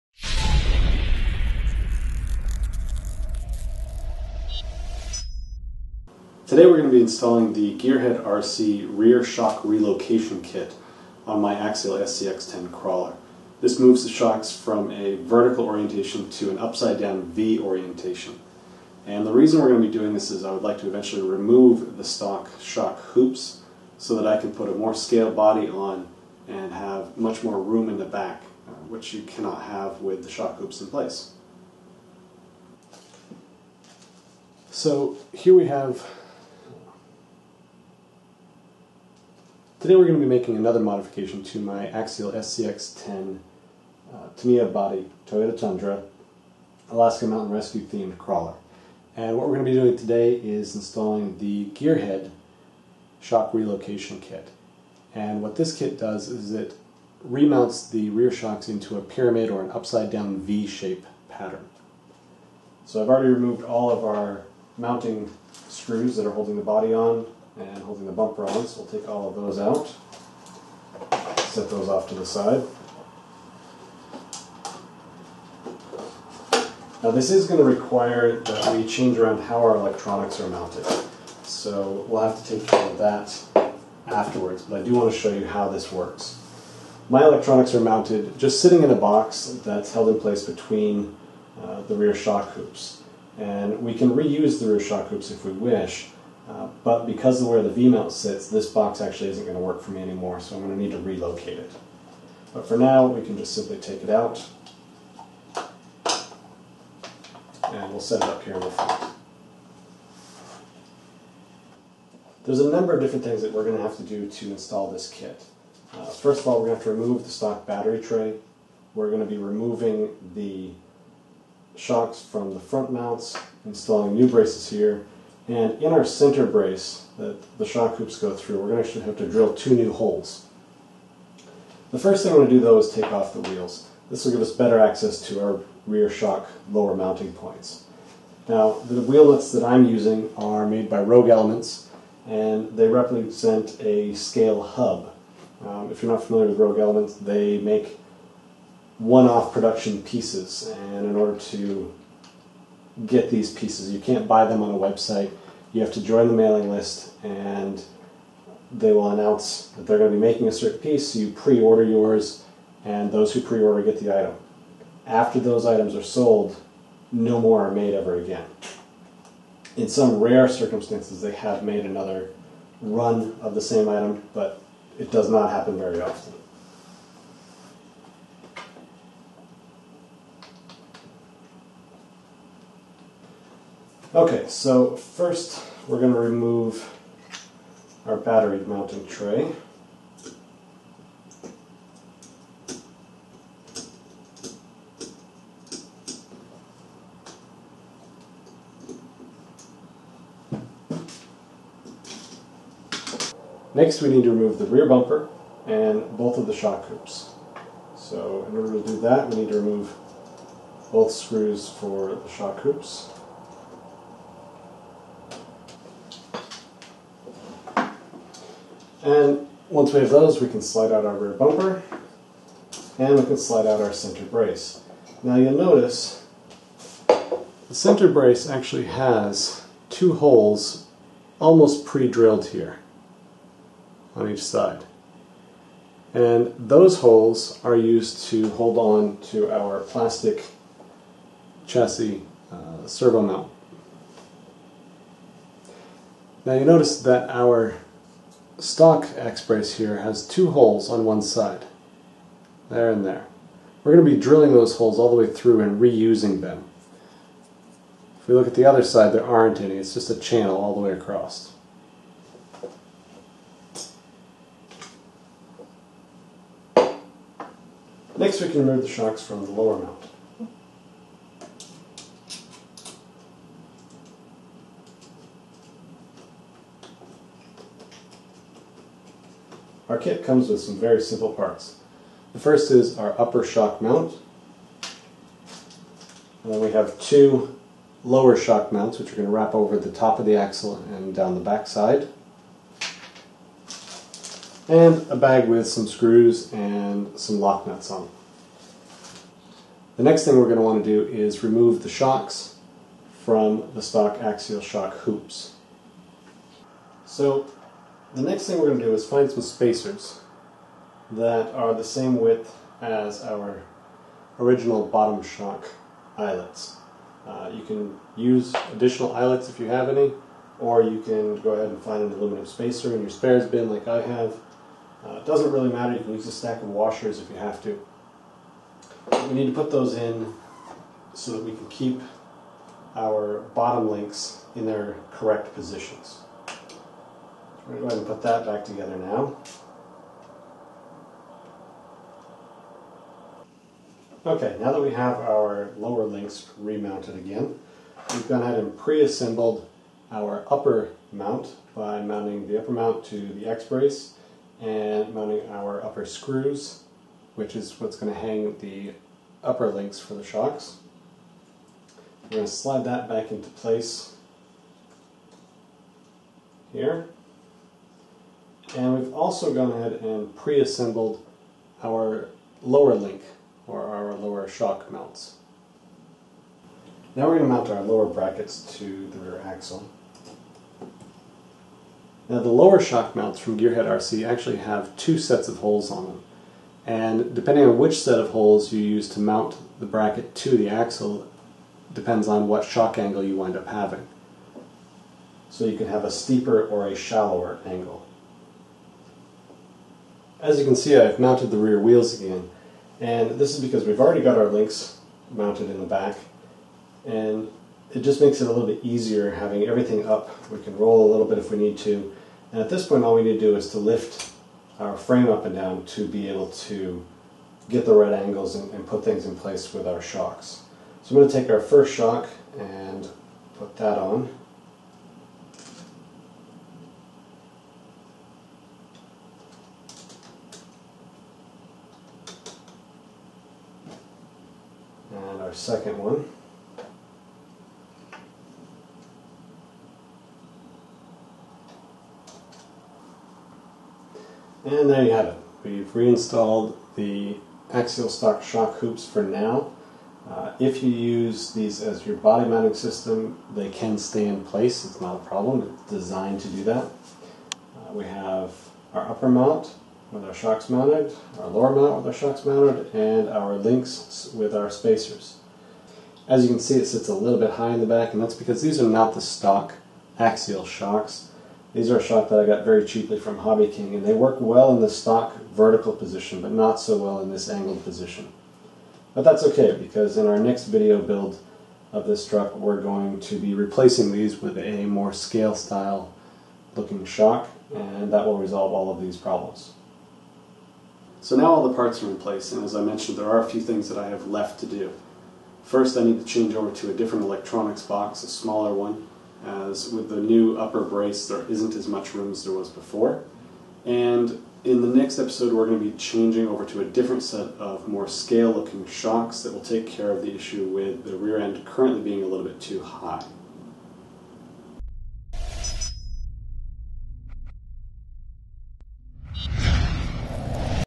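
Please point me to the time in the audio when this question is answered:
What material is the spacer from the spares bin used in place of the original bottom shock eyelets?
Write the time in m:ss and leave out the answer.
5:22.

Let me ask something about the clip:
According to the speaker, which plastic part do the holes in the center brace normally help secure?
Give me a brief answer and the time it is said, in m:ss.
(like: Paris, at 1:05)
servo mount, at 4:02.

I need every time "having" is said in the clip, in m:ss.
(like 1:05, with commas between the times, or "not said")
6:33, 6:49.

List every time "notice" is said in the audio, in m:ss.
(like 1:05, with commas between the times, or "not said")
3:45, 4:06.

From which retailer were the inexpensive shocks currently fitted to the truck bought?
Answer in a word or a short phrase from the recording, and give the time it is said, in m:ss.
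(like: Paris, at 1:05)
Hobby King, at 7:53.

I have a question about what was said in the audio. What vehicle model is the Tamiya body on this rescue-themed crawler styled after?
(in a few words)
Toyota Tundra.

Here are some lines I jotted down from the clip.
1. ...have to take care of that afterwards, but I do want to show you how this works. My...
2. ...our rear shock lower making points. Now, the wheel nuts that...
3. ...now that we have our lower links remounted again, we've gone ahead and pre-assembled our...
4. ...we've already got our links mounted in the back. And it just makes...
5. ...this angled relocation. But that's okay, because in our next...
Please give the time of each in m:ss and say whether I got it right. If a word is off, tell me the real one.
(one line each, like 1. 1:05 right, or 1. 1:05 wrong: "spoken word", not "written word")
1. 1:22 right
2. 2:15 wrong: "mounting", not "making"
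3. 5:44 right
4. 6:43 right
5. 7:57 wrong: "position", not "relocation".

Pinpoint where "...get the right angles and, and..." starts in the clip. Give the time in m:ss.
6:57.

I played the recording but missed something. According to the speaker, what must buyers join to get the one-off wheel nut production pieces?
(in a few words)
the mailing list.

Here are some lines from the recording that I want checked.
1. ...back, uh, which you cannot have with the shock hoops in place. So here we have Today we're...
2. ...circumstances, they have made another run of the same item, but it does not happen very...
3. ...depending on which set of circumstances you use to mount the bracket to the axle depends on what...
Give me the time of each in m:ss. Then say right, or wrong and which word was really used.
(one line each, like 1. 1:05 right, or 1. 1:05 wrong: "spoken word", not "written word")
1. 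0:28 right
2. 2:50 right
3. 6:27 wrong: "holes", not "circumstances".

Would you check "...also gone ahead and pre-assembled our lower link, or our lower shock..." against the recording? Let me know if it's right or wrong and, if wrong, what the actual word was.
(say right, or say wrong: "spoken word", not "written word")
right.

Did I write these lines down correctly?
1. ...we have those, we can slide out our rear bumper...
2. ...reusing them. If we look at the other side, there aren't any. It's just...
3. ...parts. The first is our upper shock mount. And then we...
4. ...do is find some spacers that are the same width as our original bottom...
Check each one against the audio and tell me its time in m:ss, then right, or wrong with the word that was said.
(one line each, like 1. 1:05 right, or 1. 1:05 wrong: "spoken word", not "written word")
1. 3:39 right
2. 4:15 right
3. 4:41 right
4. 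5:08 right.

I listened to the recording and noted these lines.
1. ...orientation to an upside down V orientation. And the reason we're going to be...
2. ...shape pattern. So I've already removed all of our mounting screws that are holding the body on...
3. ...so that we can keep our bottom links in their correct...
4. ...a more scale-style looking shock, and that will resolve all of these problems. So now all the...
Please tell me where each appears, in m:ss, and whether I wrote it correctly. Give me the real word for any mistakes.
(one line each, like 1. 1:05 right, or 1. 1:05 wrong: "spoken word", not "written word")
1. 0:15 right
2. 1:00 right
3. 5:31 right
4. 8:04 right.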